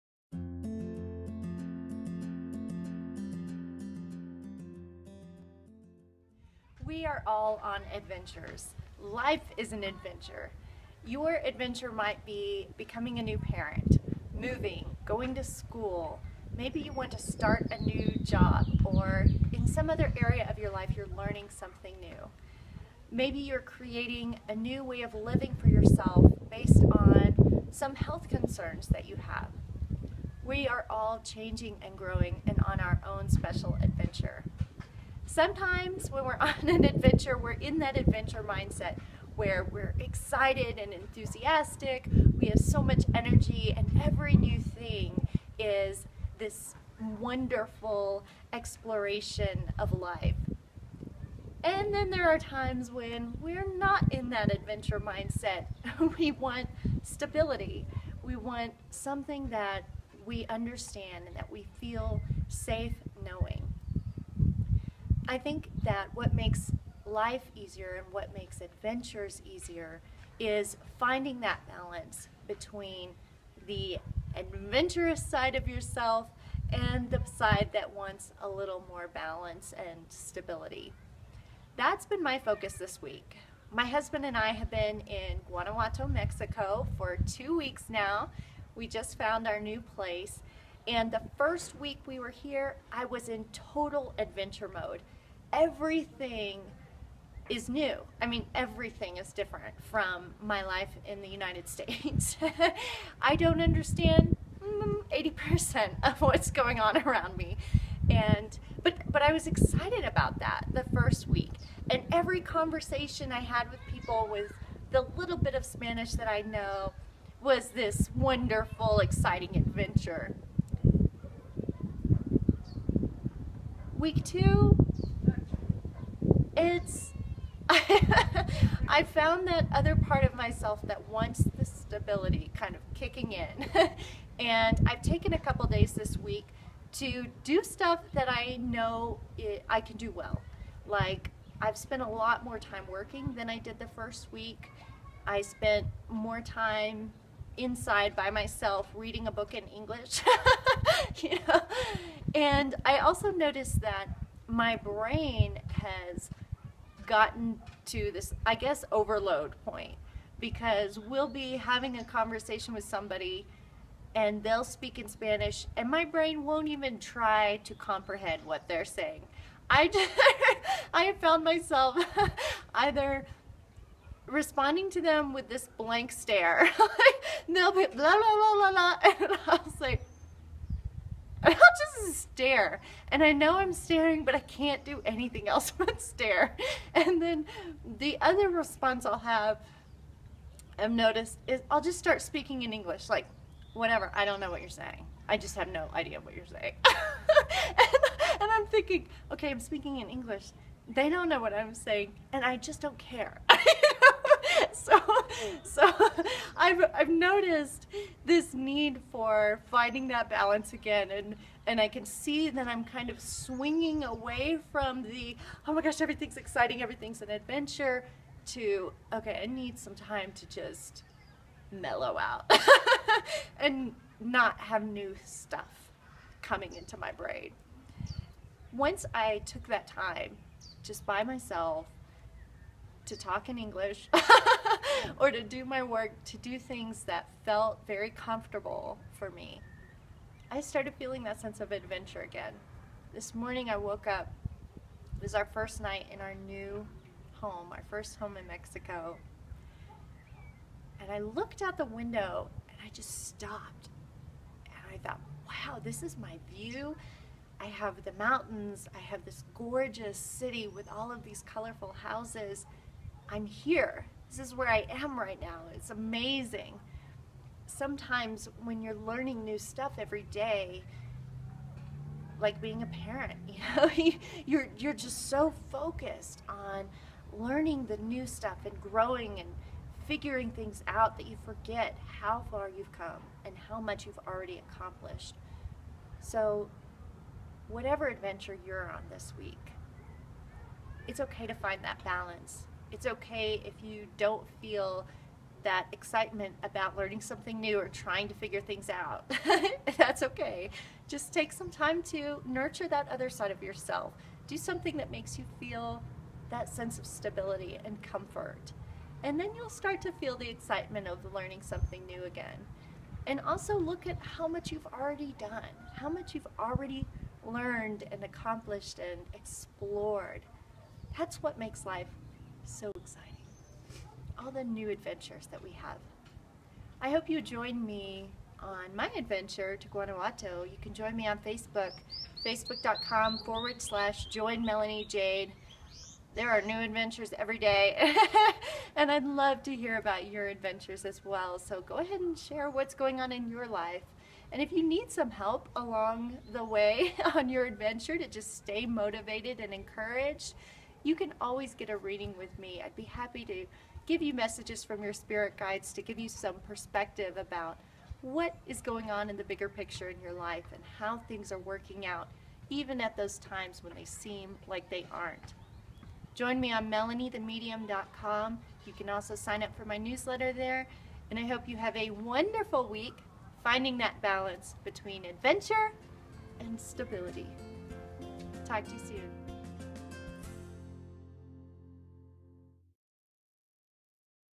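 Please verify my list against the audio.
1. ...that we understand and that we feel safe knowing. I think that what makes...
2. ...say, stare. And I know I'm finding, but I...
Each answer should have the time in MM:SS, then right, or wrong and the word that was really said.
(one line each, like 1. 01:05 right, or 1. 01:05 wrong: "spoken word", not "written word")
1. 00:59 right
2. 02:59 wrong: "staring", not "finding".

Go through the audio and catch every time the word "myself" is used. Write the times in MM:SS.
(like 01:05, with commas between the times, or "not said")
02:10, 02:28, 02:51, 03:51.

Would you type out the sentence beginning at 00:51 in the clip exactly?
And then there are times when we're not in that adventure mindset.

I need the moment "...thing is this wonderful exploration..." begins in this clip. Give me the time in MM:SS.
00:44.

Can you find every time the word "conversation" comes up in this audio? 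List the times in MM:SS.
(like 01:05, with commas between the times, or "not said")
01:52, 02:42.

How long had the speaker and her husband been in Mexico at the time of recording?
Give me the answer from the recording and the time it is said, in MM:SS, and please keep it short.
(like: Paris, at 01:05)
2 weeks, at 01:27.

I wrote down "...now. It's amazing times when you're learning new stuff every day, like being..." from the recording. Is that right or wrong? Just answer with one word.
wrong.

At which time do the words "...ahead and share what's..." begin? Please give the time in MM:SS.
05:41.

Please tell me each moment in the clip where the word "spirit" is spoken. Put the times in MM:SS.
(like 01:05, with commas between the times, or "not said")
05:55.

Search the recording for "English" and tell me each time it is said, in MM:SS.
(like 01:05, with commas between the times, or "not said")
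02:29, 03:12, 03:20, 03:53.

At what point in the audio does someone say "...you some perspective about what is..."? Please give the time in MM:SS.
05:56.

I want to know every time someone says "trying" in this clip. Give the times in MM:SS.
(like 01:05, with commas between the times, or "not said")
04:57.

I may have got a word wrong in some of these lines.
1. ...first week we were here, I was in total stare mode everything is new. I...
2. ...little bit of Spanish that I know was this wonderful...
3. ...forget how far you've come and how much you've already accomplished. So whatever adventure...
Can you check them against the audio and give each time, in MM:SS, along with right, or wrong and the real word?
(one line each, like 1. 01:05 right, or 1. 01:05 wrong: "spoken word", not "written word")
1. 01:31 wrong: "adventure", not "stare"
2. 01:55 right
3. 04:41 right.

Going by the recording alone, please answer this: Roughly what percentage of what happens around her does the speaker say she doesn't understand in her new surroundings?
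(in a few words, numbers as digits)
80%.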